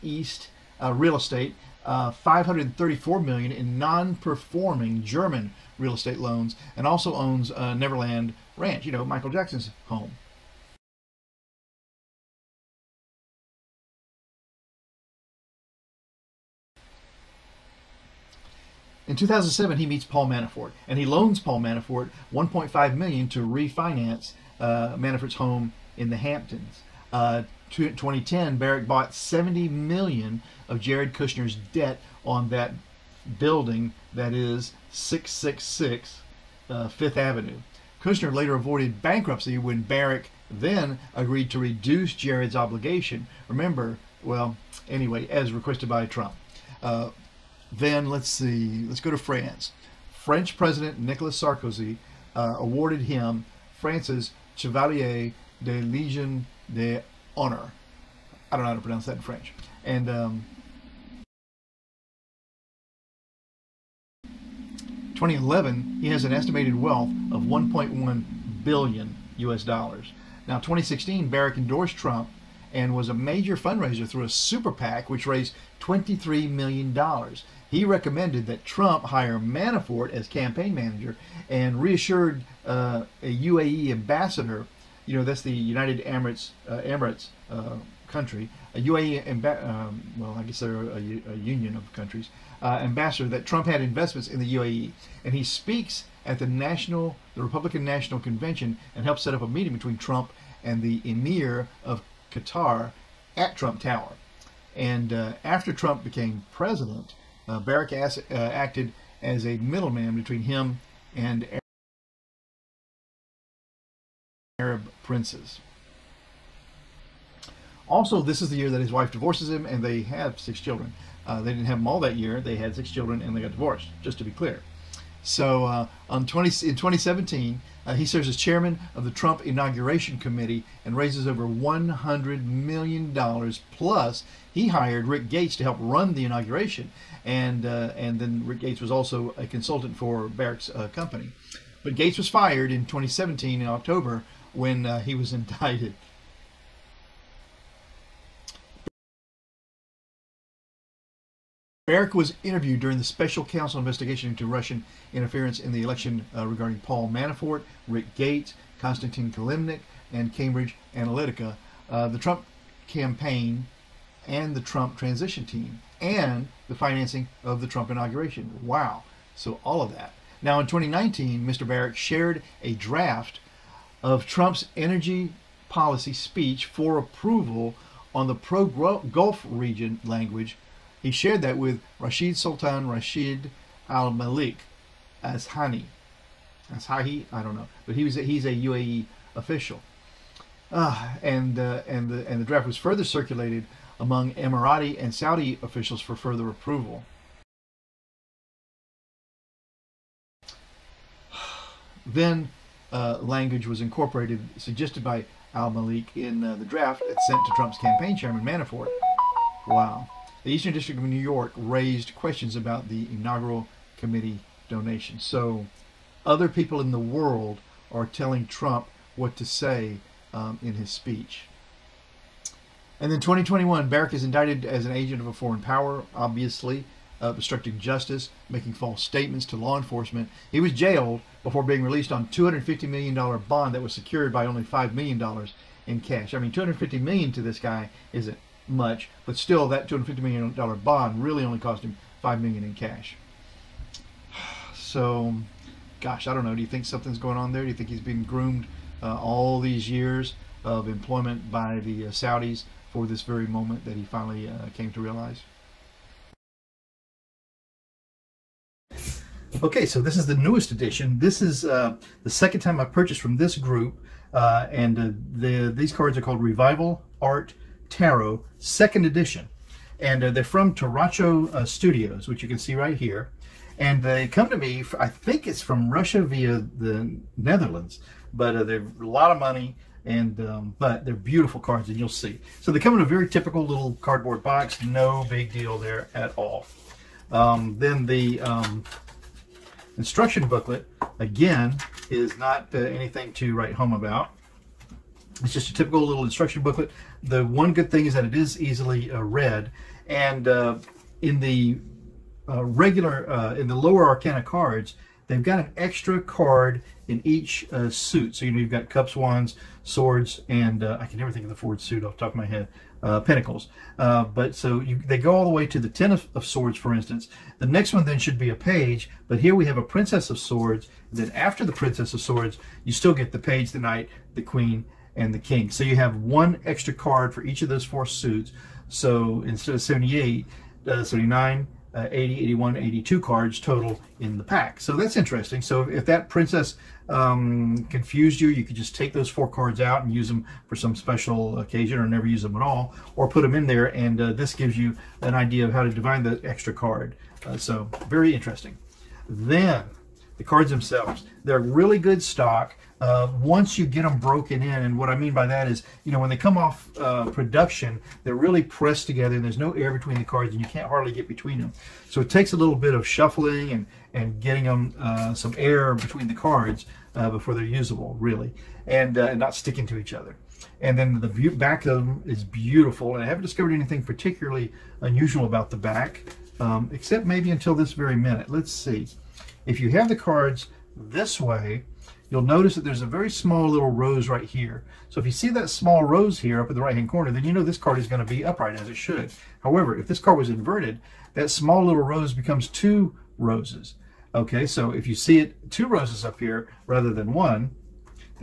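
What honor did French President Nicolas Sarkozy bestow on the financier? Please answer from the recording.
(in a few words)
Chevalier de Legion d'Honneur.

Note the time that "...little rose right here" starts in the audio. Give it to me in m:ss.
6:23.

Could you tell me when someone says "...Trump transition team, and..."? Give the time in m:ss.
2:44.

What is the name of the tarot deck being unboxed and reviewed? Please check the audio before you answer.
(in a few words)
Revival Art Tarot.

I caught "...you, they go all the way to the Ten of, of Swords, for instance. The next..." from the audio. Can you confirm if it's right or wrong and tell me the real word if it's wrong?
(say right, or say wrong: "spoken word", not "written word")
right.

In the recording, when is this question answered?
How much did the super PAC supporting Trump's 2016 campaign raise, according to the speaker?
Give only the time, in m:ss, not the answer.
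1:15.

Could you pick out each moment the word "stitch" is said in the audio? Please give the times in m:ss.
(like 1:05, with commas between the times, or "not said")
not said.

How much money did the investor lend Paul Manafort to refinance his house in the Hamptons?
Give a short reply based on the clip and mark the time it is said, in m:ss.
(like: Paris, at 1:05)
1.5 million, at 0:22.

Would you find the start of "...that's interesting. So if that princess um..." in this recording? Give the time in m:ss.
5:34.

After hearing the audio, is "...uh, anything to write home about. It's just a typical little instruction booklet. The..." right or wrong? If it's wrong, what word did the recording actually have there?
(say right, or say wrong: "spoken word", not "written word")
right.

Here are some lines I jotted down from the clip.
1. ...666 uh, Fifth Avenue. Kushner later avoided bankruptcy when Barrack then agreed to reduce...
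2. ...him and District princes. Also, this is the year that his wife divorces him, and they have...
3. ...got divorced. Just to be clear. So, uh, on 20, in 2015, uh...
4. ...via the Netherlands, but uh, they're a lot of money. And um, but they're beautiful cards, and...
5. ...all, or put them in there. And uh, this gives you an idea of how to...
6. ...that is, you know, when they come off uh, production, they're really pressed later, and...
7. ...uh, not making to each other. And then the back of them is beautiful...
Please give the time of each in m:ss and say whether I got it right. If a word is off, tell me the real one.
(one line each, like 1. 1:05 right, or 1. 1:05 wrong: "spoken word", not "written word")
1. 0:34 right
2. 1:50 wrong: "Arab", not "District"
3. 2:03 wrong: "2017", not "2015"
4. 4:36 right
5. 5:42 right
6. 5:55 wrong: "together", not "later"
7. 6:09 wrong: "sticking", not "making".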